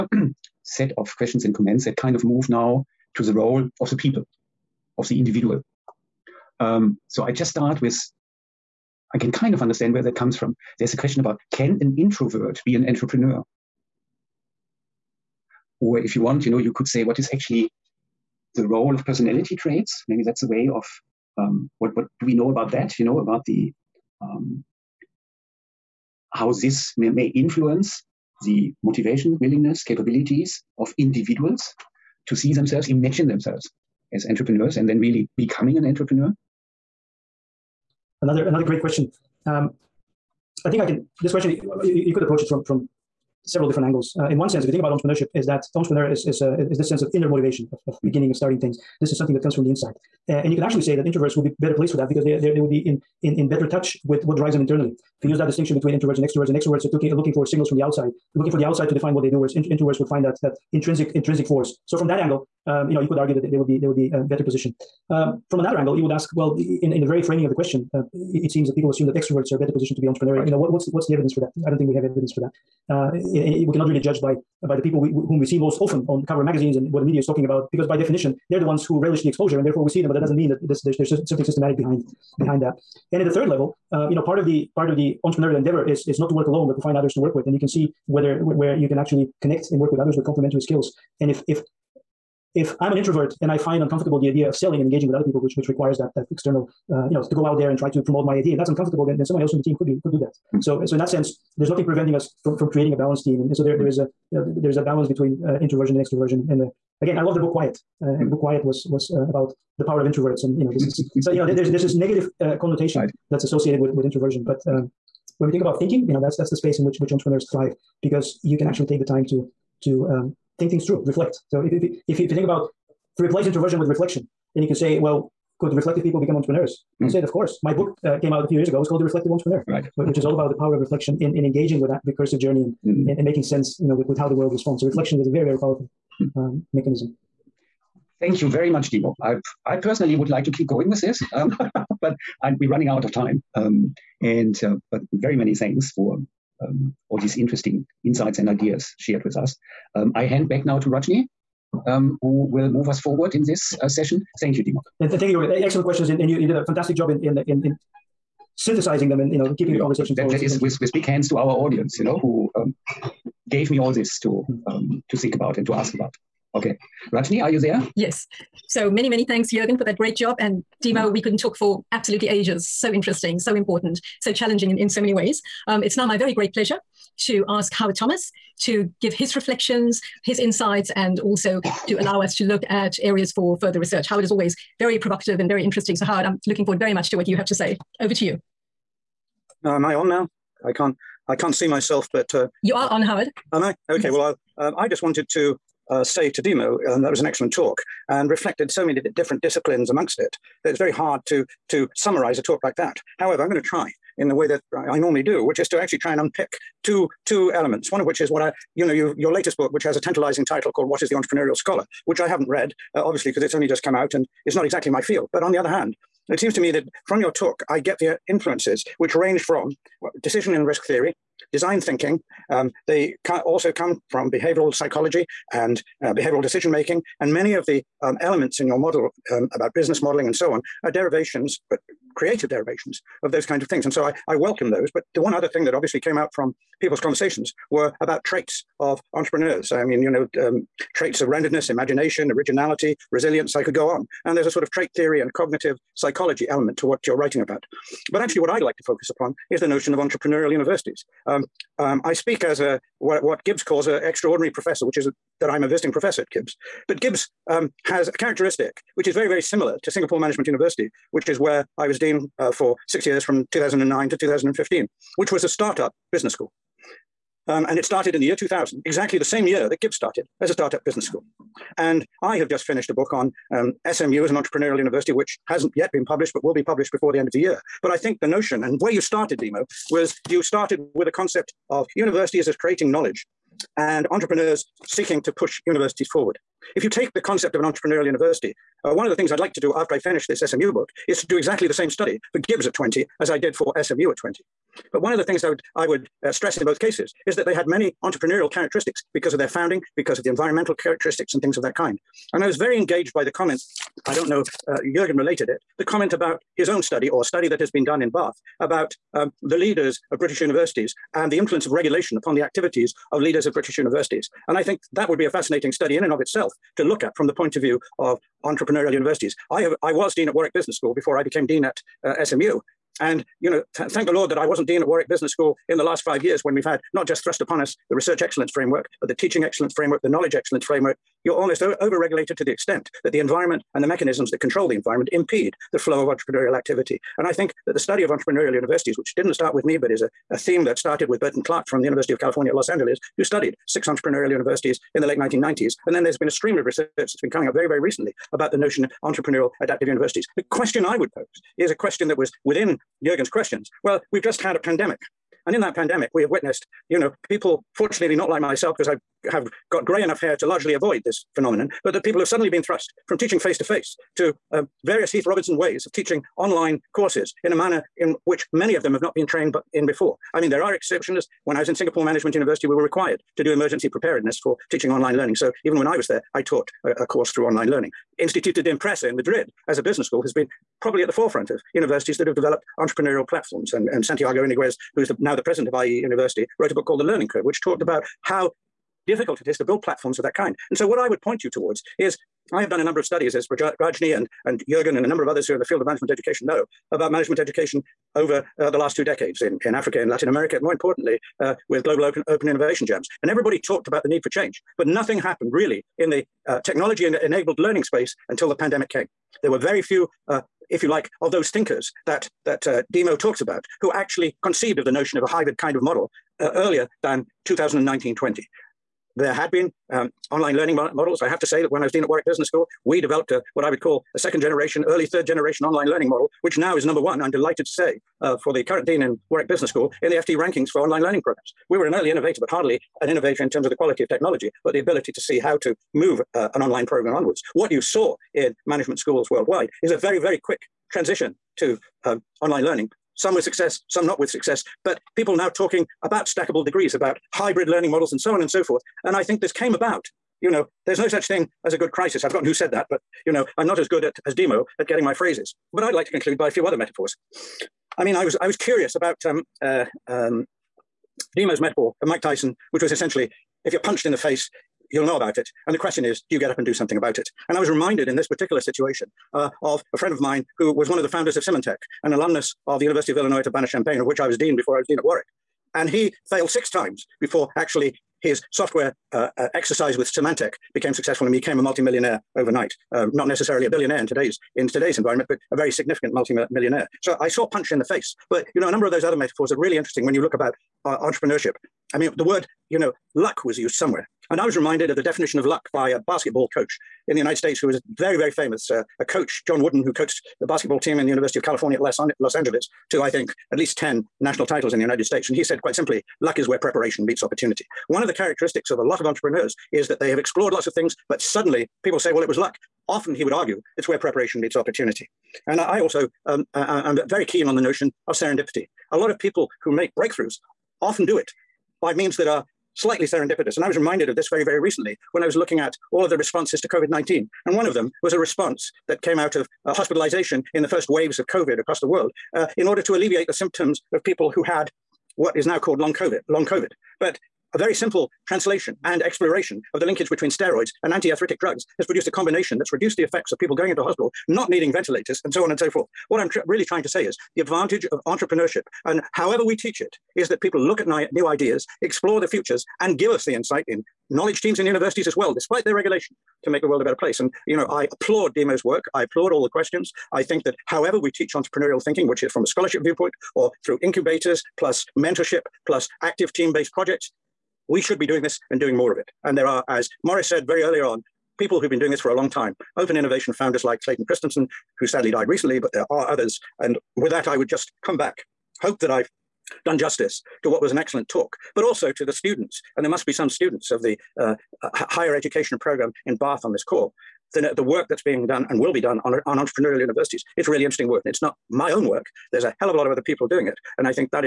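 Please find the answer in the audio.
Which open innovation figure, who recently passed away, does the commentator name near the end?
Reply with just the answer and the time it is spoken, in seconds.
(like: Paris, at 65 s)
Clayton Christensen, at 573 s.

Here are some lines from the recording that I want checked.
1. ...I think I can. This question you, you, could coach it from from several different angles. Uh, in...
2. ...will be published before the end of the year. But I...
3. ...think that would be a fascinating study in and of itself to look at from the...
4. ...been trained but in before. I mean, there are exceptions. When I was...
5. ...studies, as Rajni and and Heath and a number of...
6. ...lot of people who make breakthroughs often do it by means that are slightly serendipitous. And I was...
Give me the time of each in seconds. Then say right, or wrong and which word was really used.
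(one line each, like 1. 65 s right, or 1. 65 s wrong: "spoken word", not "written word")
1. 40 s wrong: "approach", not "coach"
2. 276 s right
3. 314 s right
4. 369 s right
5. 393 s wrong: "Jurgen", not "Heath"
6. 518 s right.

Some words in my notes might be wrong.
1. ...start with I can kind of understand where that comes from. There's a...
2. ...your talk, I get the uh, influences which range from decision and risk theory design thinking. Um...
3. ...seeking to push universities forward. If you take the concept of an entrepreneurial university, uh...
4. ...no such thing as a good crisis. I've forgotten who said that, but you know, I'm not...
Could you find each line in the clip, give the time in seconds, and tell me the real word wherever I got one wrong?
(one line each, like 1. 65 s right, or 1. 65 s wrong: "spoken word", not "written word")
1. 7 s right
2. 217 s right
3. 284 s right
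4. 450 s right.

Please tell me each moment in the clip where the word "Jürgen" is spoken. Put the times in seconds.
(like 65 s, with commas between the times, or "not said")
169 s, 304 s.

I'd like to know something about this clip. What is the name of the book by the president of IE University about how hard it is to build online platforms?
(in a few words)
The Learning Curve.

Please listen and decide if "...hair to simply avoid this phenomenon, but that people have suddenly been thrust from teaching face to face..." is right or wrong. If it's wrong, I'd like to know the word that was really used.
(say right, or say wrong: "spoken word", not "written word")
wrong: "largely", not "simply".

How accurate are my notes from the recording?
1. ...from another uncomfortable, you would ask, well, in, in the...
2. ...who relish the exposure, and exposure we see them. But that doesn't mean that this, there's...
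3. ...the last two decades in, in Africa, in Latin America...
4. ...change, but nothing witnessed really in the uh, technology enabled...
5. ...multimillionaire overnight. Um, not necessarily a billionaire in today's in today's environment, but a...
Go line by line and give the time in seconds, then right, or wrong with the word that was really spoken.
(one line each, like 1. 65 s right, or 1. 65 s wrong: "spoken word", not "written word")
1. 65 s wrong: "angle", not "uncomfortable"
2. 78 s wrong: "therefore", not "exposure"
3. 398 s right
4. 404 s wrong: "happened", not "witnessed"
5. 481 s right.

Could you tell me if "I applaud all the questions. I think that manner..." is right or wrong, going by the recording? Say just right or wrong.
wrong.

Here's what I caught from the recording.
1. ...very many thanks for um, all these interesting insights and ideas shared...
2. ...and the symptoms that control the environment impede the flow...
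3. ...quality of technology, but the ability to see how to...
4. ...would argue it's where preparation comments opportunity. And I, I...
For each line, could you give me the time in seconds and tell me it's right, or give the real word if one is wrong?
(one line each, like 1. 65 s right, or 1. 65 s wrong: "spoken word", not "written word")
1. 145 s right
2. 333 s wrong: "mechanisms", not "symptoms"
3. 433 s right
4. 513 s wrong: "meets", not "comments".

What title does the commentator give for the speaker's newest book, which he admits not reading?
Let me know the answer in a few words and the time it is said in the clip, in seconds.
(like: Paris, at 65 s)
What Is the Entrepreneurial Scholar, at 210 s.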